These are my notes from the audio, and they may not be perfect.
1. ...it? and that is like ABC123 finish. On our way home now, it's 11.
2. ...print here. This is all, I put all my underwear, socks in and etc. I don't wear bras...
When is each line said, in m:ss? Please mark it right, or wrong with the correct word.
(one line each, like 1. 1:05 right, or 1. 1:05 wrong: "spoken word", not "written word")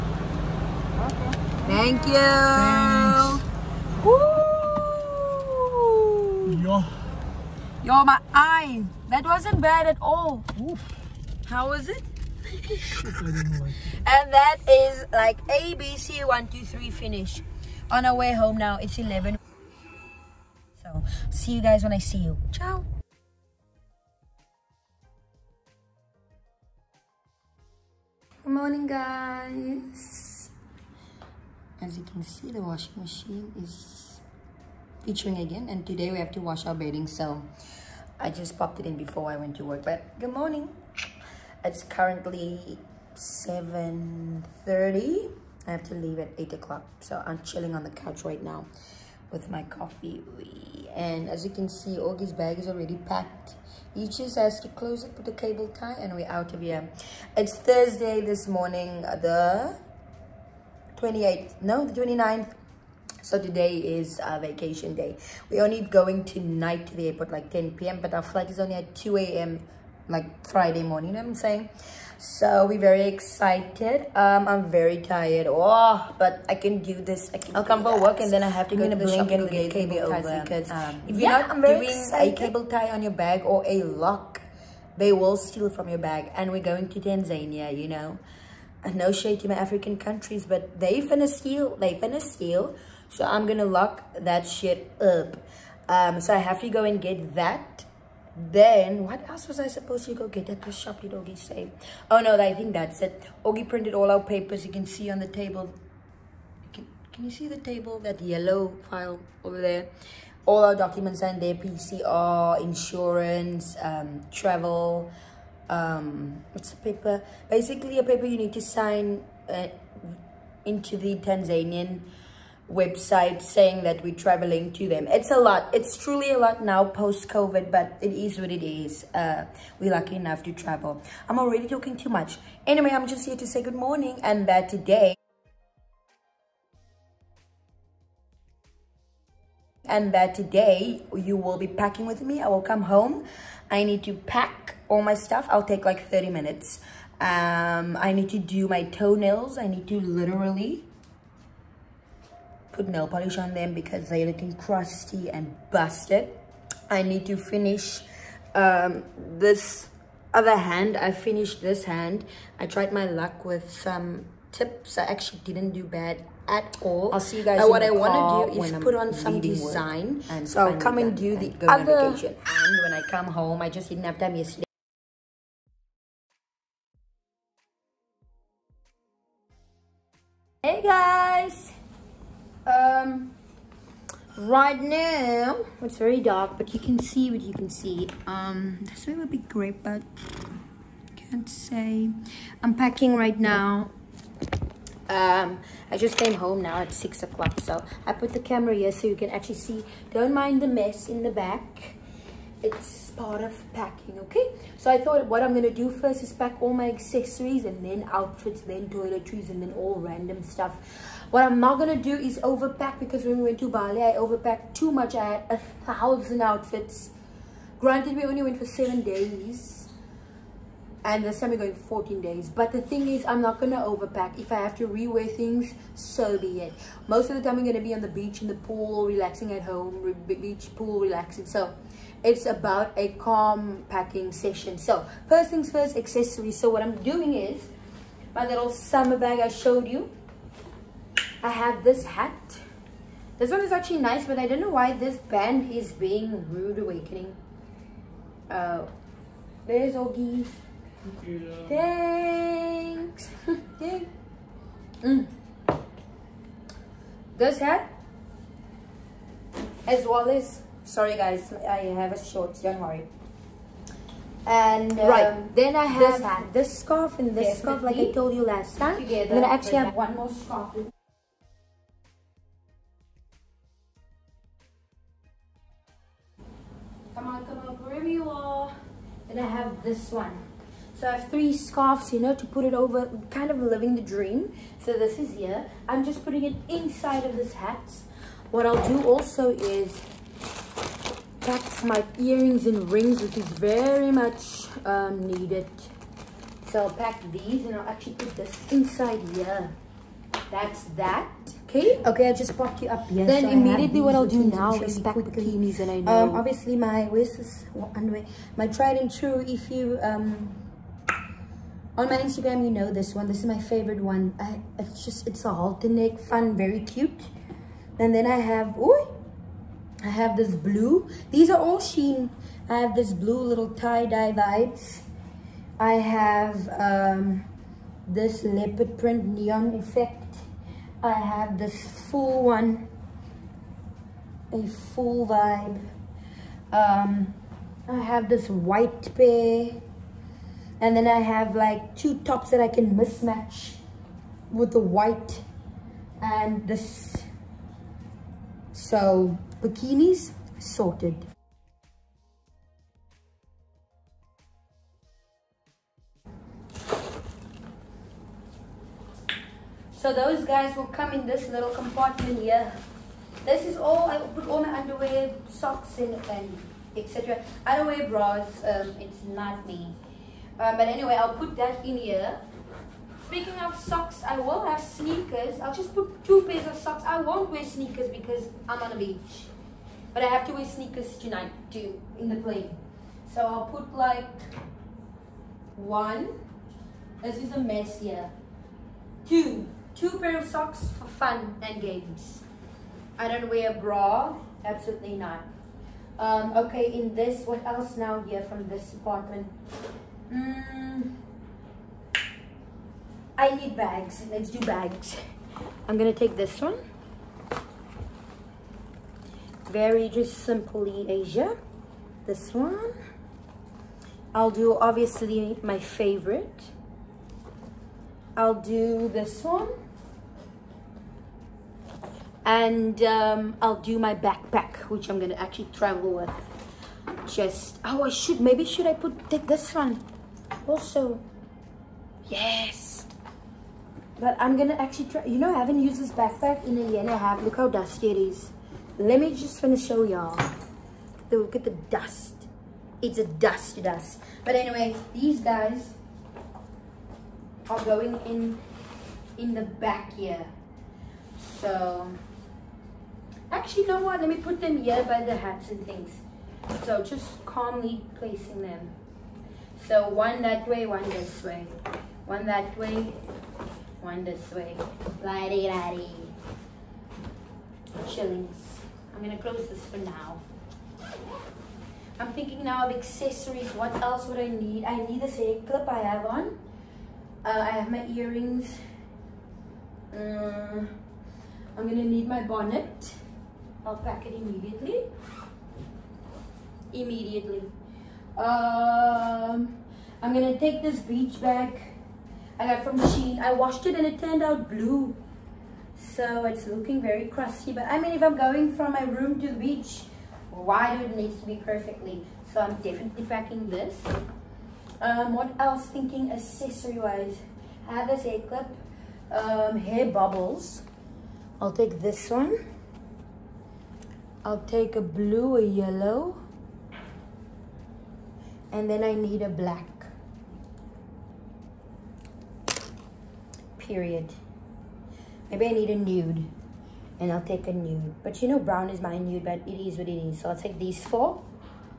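1. 0:11 right
2. 6:01 wrong: "compartment", not "print".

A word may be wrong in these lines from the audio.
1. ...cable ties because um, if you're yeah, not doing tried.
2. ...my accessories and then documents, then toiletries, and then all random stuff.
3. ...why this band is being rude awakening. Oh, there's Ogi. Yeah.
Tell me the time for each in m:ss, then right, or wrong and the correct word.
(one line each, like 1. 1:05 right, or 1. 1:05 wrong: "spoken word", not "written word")
1. 1:19 wrong: "excited", not "tried"
2. 3:26 wrong: "outfits", not "documents"
3. 4:04 right.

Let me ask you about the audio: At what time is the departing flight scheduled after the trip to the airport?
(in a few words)
2 a.m.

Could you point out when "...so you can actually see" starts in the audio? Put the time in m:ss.
3:18.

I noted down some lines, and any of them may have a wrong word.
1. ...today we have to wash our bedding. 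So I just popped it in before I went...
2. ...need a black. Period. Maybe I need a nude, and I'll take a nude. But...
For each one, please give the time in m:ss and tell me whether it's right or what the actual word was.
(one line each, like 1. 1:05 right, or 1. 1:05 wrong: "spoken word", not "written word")
1. 0:35 right
2. 8:39 right.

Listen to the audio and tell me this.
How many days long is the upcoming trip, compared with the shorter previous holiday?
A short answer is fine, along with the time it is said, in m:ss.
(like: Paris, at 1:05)
14, at 3:41.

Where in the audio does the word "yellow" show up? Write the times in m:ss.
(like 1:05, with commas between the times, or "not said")
1:48, 8:35.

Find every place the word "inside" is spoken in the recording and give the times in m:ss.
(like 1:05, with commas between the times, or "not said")
4:46, 4:58.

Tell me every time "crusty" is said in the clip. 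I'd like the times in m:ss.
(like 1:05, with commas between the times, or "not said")
2:34, 8:17.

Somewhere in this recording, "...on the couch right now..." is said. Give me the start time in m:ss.
0:47.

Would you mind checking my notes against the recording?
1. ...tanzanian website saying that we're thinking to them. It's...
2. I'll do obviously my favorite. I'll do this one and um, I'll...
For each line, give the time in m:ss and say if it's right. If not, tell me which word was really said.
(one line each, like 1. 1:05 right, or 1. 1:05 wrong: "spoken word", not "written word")
1. 2:01 wrong: "traveling", not "thinking"
2. 6:54 right.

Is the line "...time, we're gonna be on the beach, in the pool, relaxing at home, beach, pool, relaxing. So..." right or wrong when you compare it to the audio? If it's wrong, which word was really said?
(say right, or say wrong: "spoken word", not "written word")
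right.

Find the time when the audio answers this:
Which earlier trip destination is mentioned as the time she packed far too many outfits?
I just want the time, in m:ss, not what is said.
3:33.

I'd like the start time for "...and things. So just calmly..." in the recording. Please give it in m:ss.
7:35.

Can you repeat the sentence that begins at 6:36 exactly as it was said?
Um, okay, in this, what else now here from this department?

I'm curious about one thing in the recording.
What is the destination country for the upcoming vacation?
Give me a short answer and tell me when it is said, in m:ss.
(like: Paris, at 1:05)
Tanzania, at 1:27.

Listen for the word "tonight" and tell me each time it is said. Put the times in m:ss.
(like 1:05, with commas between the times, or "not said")
1:06, 6:21.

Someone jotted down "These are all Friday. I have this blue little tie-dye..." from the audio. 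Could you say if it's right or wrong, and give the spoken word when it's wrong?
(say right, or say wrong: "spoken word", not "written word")
wrong: "Shein", not "Friday".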